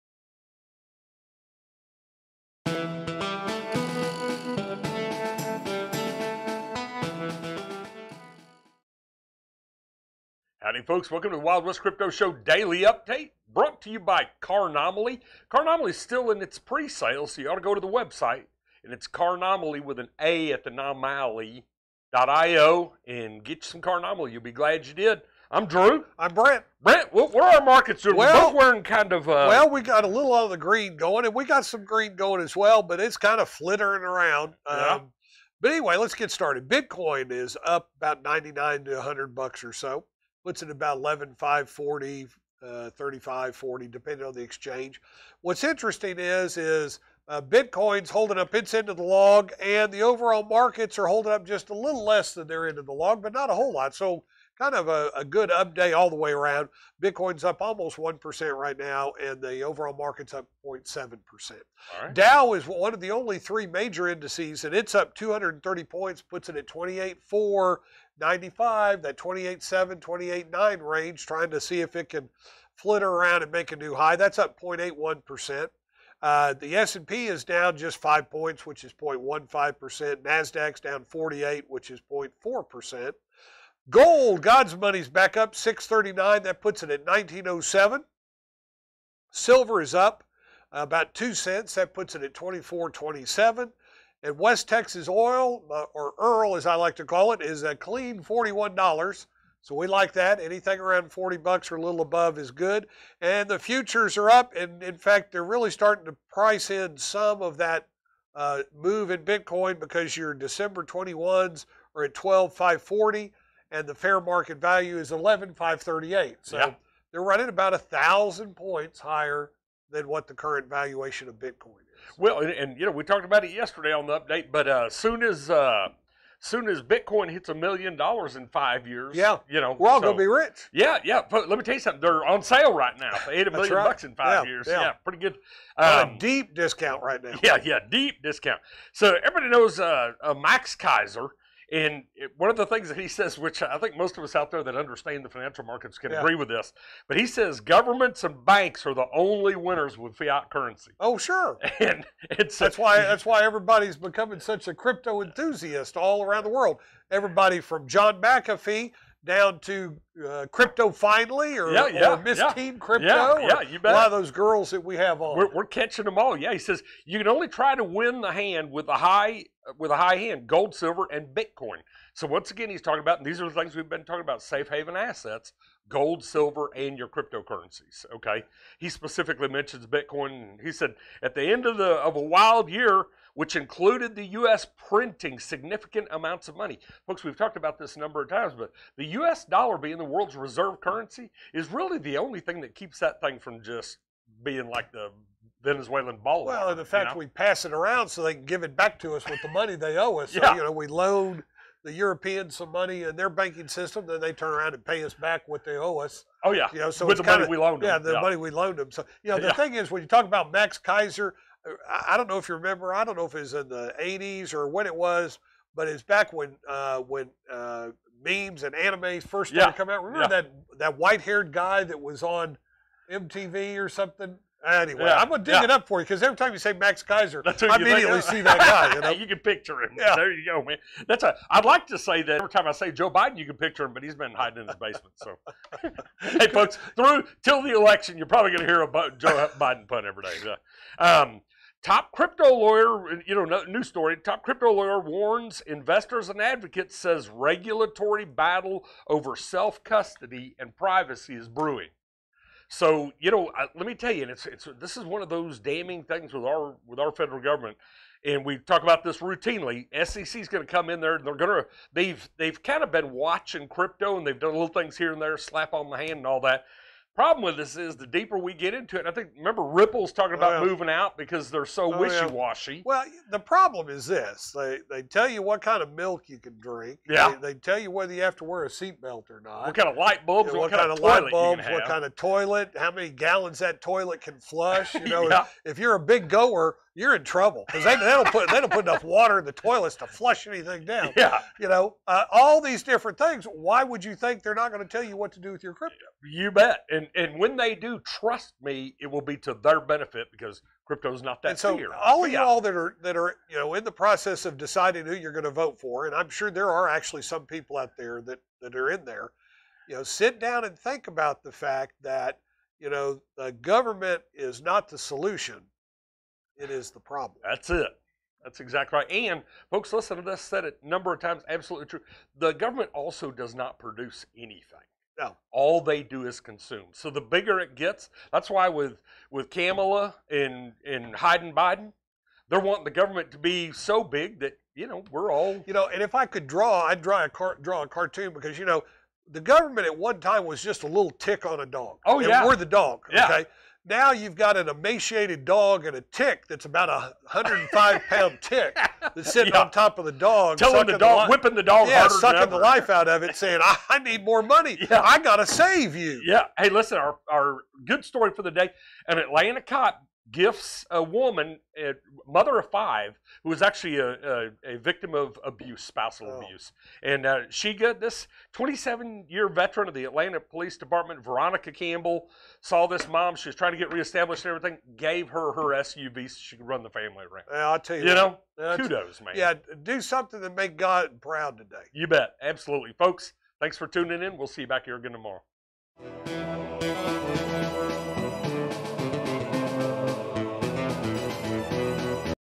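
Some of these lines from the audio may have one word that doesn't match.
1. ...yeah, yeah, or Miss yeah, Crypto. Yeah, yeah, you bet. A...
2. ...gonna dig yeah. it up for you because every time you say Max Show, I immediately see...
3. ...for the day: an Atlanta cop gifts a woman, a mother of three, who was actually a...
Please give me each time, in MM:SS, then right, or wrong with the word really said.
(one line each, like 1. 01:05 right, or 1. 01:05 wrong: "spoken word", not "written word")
1. 02:41 right
2. 03:45 wrong: "Keiser", not "Show"
3. 05:58 wrong: "five", not "three".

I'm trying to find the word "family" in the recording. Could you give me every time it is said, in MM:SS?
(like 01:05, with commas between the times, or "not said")
06:16.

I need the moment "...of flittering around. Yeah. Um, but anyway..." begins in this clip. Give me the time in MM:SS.
00:33.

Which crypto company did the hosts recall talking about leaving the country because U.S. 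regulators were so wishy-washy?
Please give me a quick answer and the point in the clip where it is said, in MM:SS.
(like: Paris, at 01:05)
Ripple, at 04:29.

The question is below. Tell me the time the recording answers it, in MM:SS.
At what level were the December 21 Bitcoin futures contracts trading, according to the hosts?
01:52.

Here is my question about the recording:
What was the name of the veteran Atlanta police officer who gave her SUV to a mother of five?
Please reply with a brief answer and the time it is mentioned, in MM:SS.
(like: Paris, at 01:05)
Veronica Campbell, at 06:11.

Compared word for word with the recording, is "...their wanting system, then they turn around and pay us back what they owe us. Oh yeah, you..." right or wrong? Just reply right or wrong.
wrong.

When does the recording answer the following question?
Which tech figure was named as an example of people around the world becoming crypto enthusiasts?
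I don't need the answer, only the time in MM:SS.
02:37.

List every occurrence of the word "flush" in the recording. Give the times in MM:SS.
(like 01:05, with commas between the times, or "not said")
04:44, 04:50.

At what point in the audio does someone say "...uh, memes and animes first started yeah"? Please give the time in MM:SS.
03:37.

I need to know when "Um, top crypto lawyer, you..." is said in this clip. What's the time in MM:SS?
04:01.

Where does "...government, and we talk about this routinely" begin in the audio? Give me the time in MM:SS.
04:17.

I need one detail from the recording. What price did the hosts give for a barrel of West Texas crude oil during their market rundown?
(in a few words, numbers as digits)
$41.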